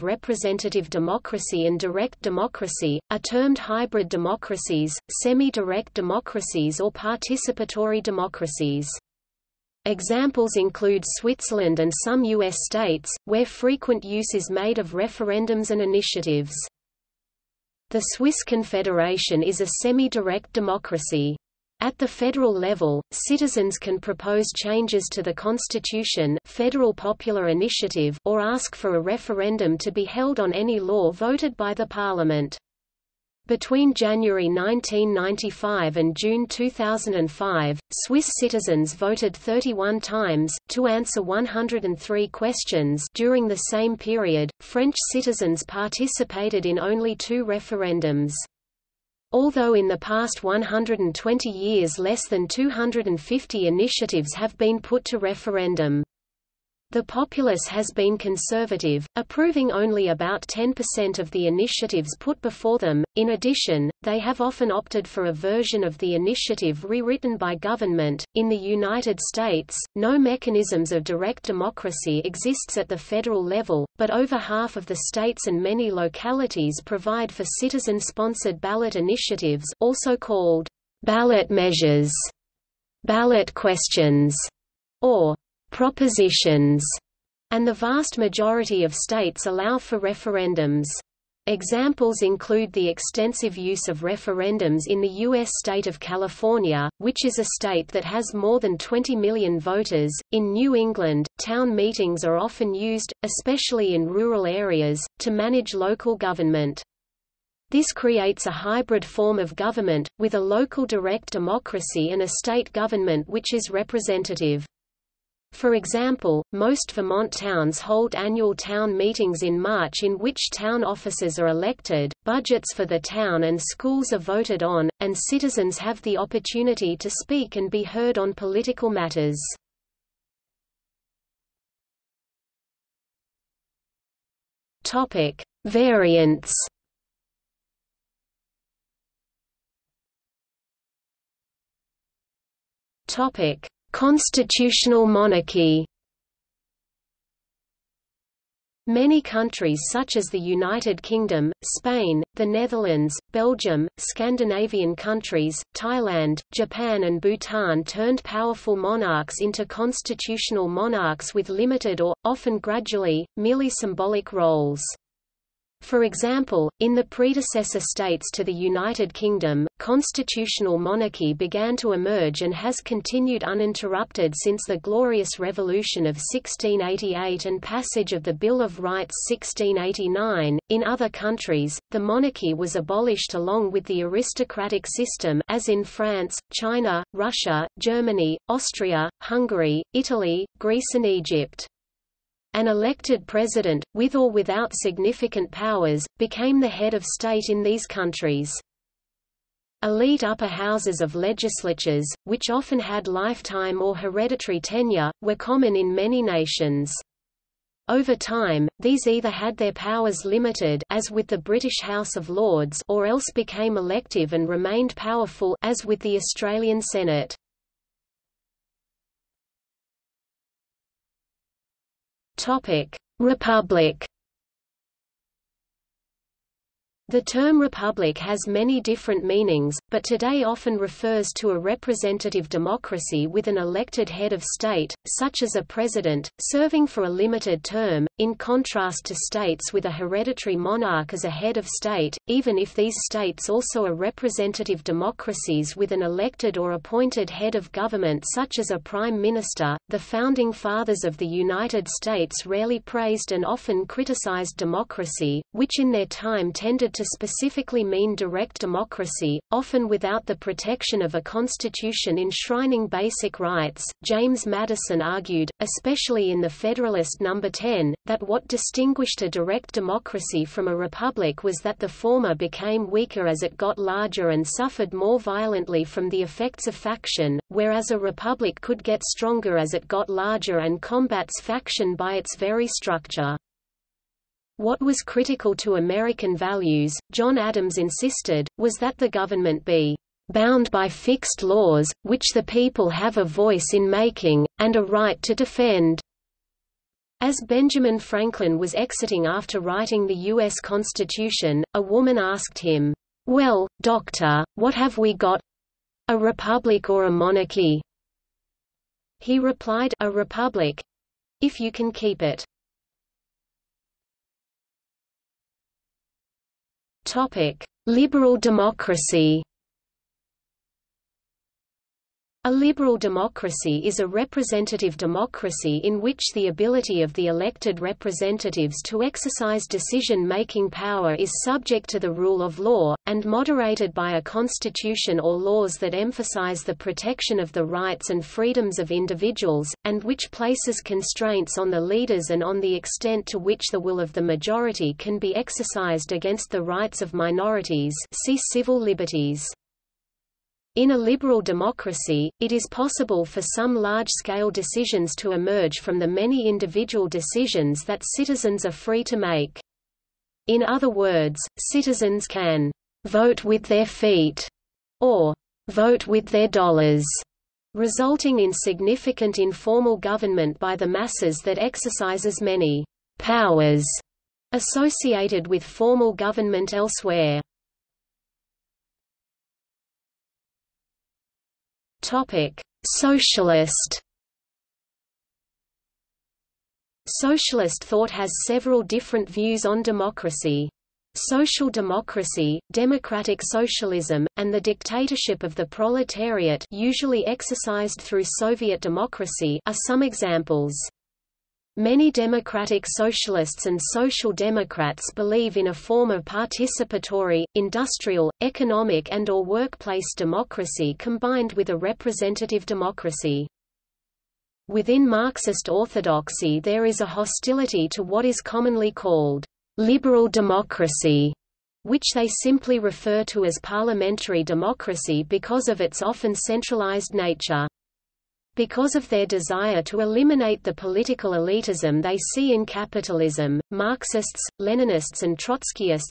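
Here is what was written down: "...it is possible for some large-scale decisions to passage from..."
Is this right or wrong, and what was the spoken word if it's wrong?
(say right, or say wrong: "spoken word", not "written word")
wrong: "emerge", not "passage".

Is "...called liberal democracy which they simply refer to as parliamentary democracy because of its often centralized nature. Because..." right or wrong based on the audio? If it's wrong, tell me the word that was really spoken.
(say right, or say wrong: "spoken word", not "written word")
right.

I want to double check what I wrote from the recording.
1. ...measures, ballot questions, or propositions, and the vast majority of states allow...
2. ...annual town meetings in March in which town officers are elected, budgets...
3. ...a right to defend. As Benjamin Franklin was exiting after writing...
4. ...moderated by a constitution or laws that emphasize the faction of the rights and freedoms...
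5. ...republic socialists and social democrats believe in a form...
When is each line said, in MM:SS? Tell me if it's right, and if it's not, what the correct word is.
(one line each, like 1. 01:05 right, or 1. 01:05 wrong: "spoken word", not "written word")
1. 01:21 right
2. 01:58 right
3. 04:54 right
4. 05:33 wrong: "protection", not "faction"
5. 06:42 wrong: "democratic", not "republic".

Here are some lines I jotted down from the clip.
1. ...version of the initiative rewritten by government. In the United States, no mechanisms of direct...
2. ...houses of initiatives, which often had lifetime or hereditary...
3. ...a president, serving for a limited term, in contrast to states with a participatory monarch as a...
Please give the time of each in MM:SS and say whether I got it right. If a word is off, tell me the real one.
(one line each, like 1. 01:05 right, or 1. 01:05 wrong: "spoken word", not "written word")
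1. 01:05 right
2. 03:20 wrong: "legislatures", not "initiatives"
3. 03:55 wrong: "hereditary", not "participatory".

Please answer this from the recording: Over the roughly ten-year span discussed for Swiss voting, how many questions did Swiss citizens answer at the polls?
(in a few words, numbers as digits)
103.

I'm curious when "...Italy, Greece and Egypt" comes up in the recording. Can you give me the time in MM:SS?
03:09.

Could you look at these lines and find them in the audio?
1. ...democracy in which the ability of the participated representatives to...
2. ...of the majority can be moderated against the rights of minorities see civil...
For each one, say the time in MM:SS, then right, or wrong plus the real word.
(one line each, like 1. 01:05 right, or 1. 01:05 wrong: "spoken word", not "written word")
1. 05:24 wrong: "elected", not "participated"
2. 05:43 wrong: "exercised", not "moderated".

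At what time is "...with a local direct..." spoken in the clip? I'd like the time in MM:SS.
01:50.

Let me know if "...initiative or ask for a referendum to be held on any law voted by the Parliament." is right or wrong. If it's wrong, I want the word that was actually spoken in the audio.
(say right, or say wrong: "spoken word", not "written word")
right.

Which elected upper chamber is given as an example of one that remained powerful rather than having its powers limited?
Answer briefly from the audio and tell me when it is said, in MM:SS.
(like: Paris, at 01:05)
Australian Senate, at 03:36.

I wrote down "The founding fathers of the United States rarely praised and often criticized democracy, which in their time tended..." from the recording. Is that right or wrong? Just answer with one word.
right.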